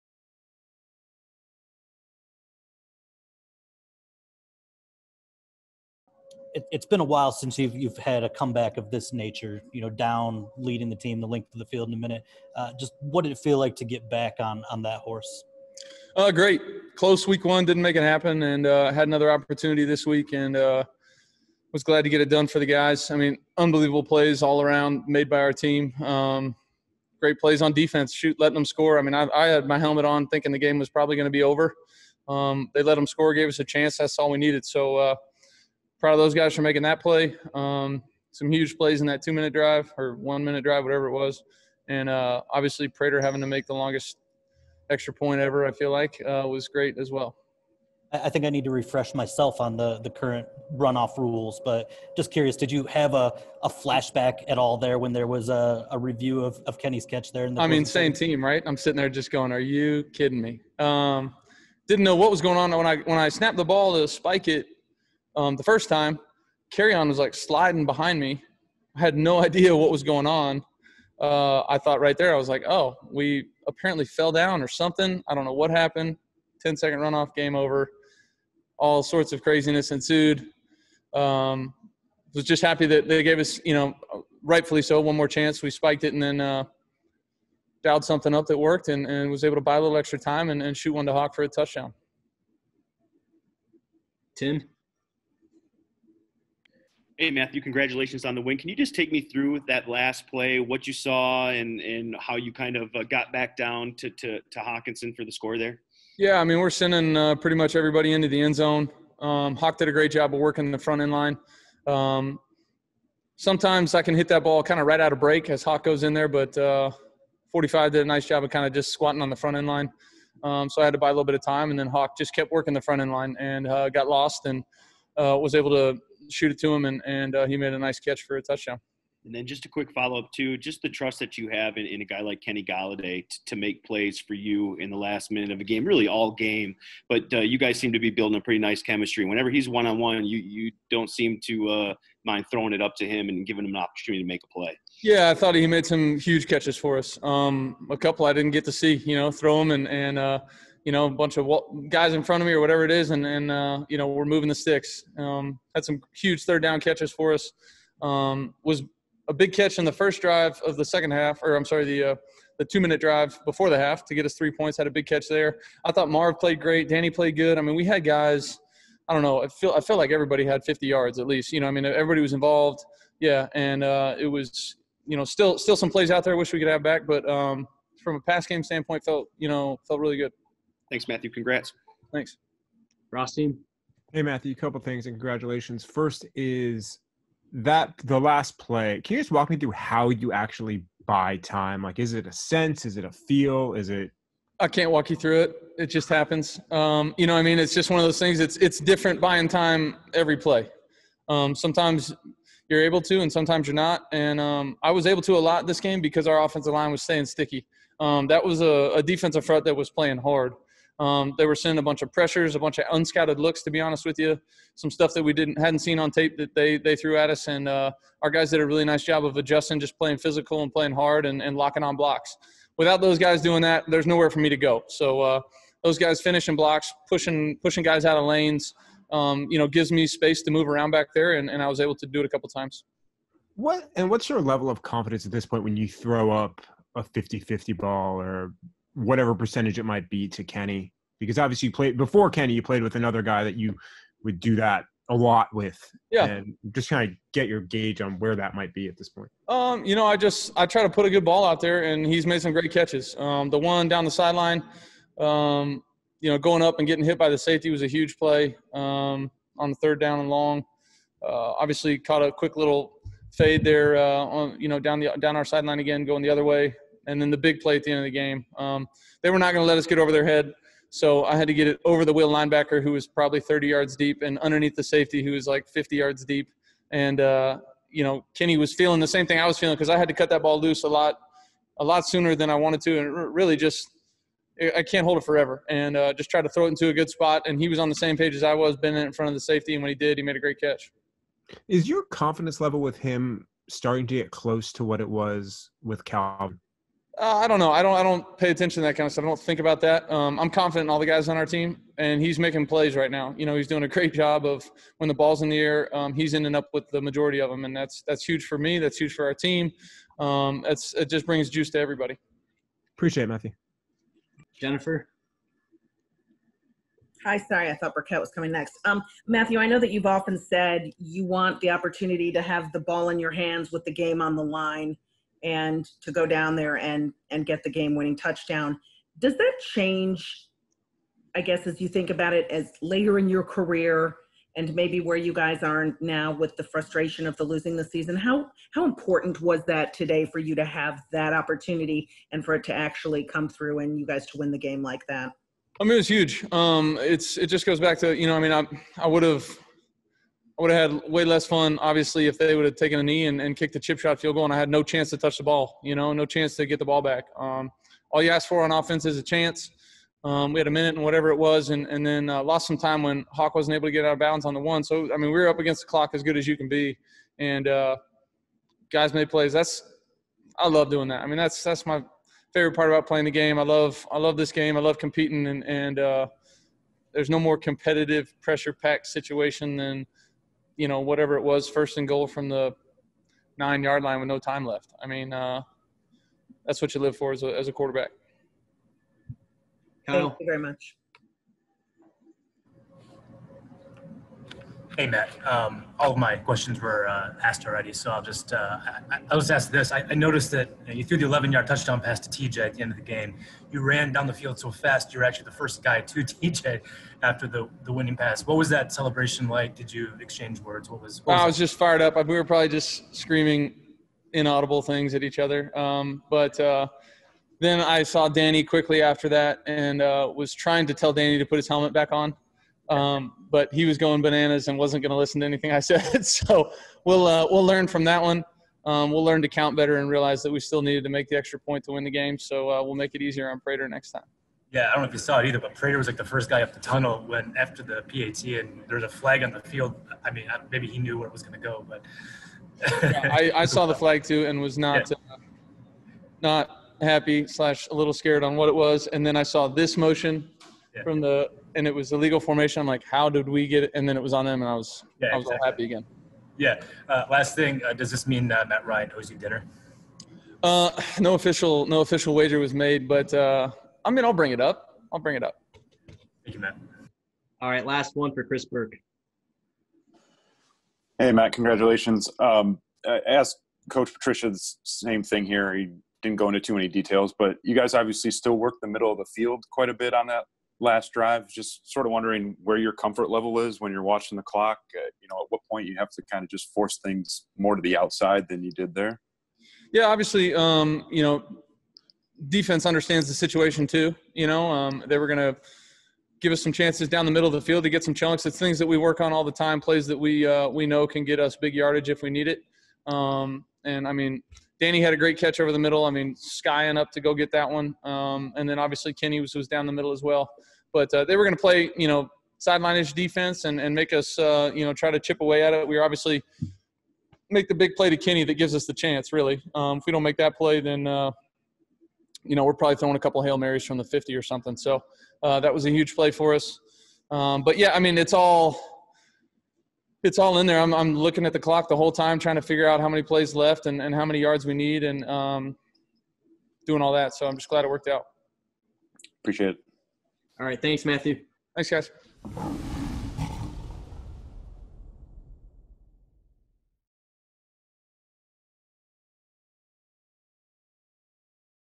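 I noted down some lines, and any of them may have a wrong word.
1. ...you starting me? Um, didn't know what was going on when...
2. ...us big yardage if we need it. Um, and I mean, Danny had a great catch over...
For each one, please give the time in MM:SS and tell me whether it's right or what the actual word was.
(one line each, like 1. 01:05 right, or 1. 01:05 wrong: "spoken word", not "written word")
1. 00:59 wrong: "kidding", not "starting"
2. 08:21 right.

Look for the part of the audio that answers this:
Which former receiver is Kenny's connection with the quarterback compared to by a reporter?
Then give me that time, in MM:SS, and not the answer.
04:56.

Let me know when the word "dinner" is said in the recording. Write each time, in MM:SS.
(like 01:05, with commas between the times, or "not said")
07:39.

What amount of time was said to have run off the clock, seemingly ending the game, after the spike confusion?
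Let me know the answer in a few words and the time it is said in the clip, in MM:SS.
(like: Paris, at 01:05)
10 second, at 01:16.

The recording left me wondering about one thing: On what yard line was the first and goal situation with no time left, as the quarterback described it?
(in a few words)
9.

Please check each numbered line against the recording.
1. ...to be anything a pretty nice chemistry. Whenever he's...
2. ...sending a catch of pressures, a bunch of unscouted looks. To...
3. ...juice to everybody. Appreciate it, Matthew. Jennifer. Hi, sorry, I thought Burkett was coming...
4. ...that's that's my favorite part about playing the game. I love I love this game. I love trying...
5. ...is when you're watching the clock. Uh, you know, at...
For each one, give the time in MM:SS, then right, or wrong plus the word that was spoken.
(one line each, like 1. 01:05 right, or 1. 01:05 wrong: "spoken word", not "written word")
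1. 02:17 wrong: "building", not "anything"
2. 03:31 wrong: "bunch", not "catch"
3. 05:11 right
4. 06:11 wrong: "competing", not "trying"
5. 08:03 right.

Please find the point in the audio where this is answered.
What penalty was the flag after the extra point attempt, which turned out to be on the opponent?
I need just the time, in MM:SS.
07:32.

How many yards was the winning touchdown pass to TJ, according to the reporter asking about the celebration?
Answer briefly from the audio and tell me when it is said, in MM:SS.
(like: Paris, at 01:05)
11, at 06:41.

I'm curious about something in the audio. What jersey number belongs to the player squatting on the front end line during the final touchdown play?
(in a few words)
45.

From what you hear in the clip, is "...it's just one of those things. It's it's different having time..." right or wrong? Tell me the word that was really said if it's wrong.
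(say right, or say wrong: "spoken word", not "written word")
wrong: "buying", not "having".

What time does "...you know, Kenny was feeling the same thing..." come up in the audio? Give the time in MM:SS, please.
04:37.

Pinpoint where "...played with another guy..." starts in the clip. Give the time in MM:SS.
04:02.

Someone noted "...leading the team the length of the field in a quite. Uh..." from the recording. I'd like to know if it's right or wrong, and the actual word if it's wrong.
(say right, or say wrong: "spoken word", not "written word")
wrong: "minute", not "quite".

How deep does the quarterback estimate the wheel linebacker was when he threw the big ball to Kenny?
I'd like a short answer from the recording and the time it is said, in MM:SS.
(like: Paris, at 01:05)
30 yards, at 04:33.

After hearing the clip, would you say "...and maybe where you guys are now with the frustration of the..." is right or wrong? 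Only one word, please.
right.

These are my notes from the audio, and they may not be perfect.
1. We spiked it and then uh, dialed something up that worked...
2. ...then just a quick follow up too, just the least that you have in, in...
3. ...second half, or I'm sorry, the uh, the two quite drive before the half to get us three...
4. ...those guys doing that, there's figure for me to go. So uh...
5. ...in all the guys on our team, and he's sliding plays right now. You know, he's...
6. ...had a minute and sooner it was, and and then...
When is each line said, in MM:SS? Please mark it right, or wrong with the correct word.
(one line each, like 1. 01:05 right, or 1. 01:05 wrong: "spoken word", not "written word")
1. 01:25 right
2. 02:09 wrong: "trust", not "least"
3. 02:40 wrong: "minute", not "quite"
4. 03:43 wrong: "nowhere", not "figure"
5. 05:00 wrong: "making", not "sliding"
6. 06:00 wrong: "whatever", not "sooner".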